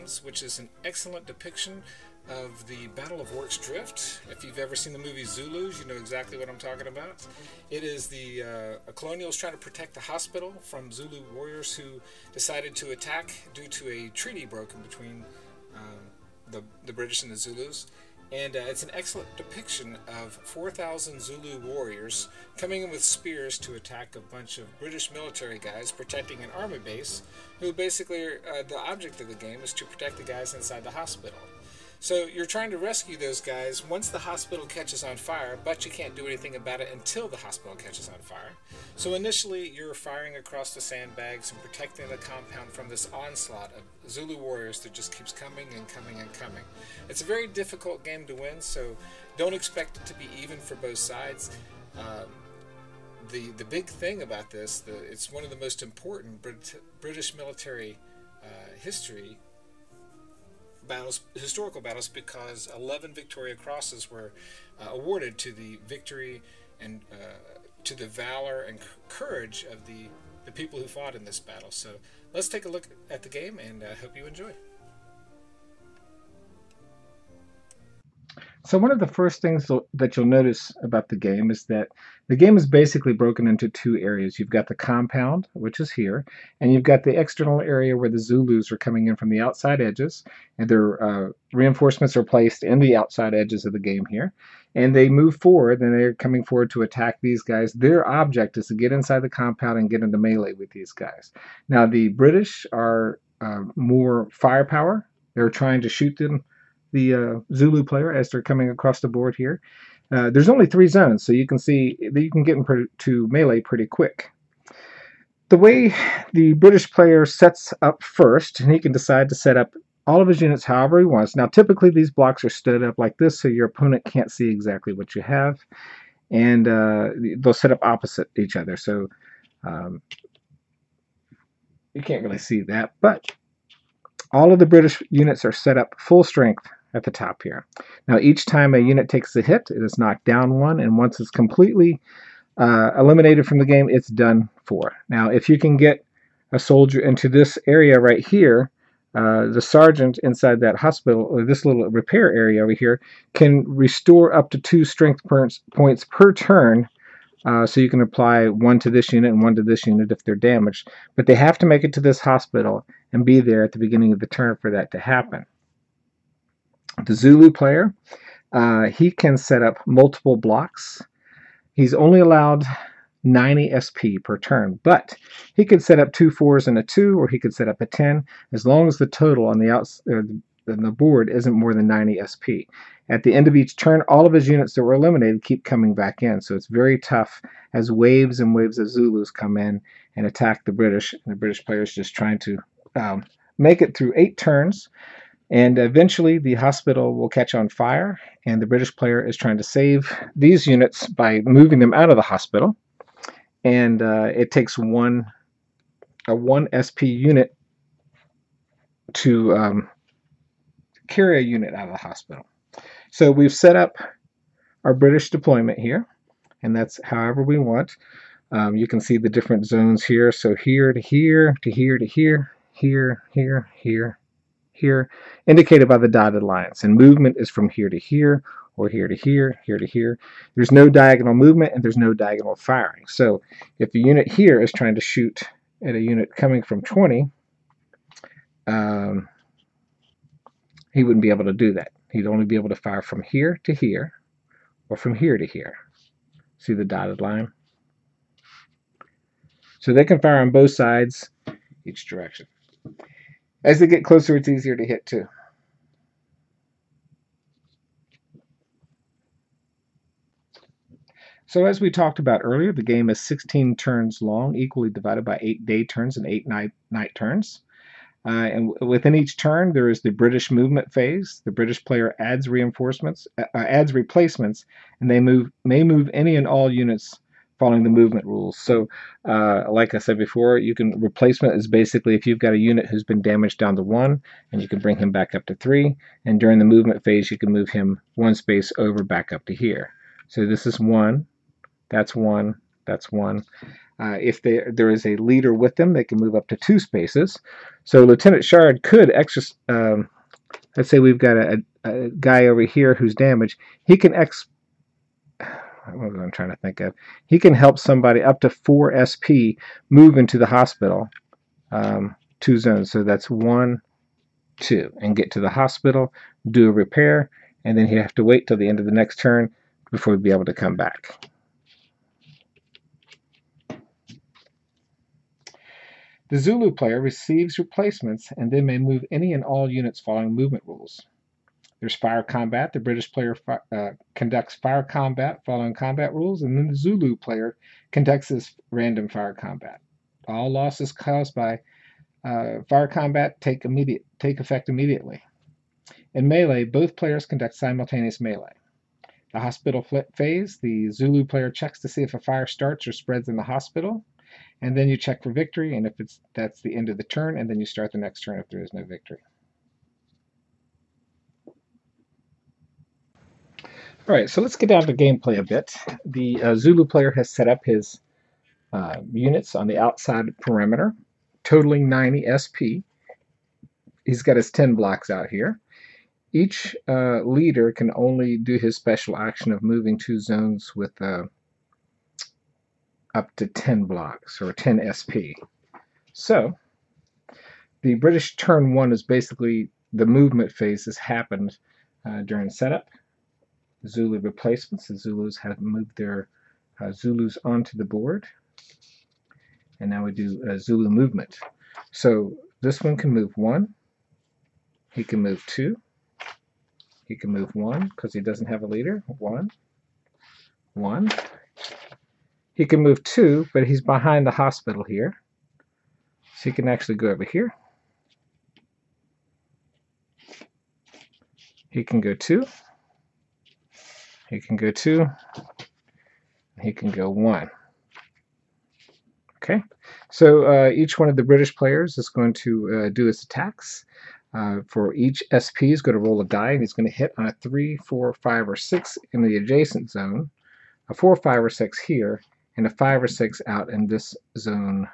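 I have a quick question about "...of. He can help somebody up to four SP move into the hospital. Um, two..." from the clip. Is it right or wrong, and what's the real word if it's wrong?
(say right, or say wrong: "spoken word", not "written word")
right.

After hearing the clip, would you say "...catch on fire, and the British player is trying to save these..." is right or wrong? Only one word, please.
right.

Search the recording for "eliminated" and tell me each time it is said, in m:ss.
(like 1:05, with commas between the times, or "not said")
2:22, 3:04.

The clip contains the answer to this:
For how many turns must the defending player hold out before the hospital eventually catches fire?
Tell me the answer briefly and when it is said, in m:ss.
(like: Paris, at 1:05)
eight, at 3:14.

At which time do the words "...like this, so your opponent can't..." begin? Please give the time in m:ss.
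2:02.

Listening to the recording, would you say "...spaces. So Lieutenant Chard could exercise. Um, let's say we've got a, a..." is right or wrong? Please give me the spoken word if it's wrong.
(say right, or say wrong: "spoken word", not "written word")
right.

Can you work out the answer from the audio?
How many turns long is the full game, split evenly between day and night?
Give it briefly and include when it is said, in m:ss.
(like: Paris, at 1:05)
16, at 4:23.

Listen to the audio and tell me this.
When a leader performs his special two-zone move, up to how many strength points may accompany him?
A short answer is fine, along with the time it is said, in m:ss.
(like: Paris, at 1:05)
10 SP, at 6:24.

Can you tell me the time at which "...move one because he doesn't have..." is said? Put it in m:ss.
6:47.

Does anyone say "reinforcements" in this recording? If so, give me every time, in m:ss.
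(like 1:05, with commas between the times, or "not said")
1:31, 4:32.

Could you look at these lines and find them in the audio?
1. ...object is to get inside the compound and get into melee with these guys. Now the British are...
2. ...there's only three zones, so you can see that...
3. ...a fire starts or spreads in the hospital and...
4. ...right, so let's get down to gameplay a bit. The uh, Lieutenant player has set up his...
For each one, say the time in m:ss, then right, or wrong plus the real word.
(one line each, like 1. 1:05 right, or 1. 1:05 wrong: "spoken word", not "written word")
1. 1:38 right
2. 1:50 right
3. 5:52 right
4. 6:04 wrong: "Zulu", not "Lieutenant".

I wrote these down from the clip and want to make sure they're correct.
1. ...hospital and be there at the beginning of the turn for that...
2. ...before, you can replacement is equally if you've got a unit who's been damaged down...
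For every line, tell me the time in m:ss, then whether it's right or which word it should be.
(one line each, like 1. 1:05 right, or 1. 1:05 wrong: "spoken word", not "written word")
1. 2:42 right
2. 4:40 wrong: "basically", not "equally".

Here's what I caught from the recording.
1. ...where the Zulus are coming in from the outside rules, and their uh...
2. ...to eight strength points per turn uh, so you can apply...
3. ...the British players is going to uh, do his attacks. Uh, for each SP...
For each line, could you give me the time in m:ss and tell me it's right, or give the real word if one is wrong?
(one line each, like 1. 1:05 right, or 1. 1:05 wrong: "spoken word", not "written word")
1. 1:27 wrong: "edges", not "rules"
2. 2:34 wrong: "two", not "eight"
3. 7:11 right.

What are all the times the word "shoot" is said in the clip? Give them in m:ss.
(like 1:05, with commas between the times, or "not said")
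1:45, 3:55.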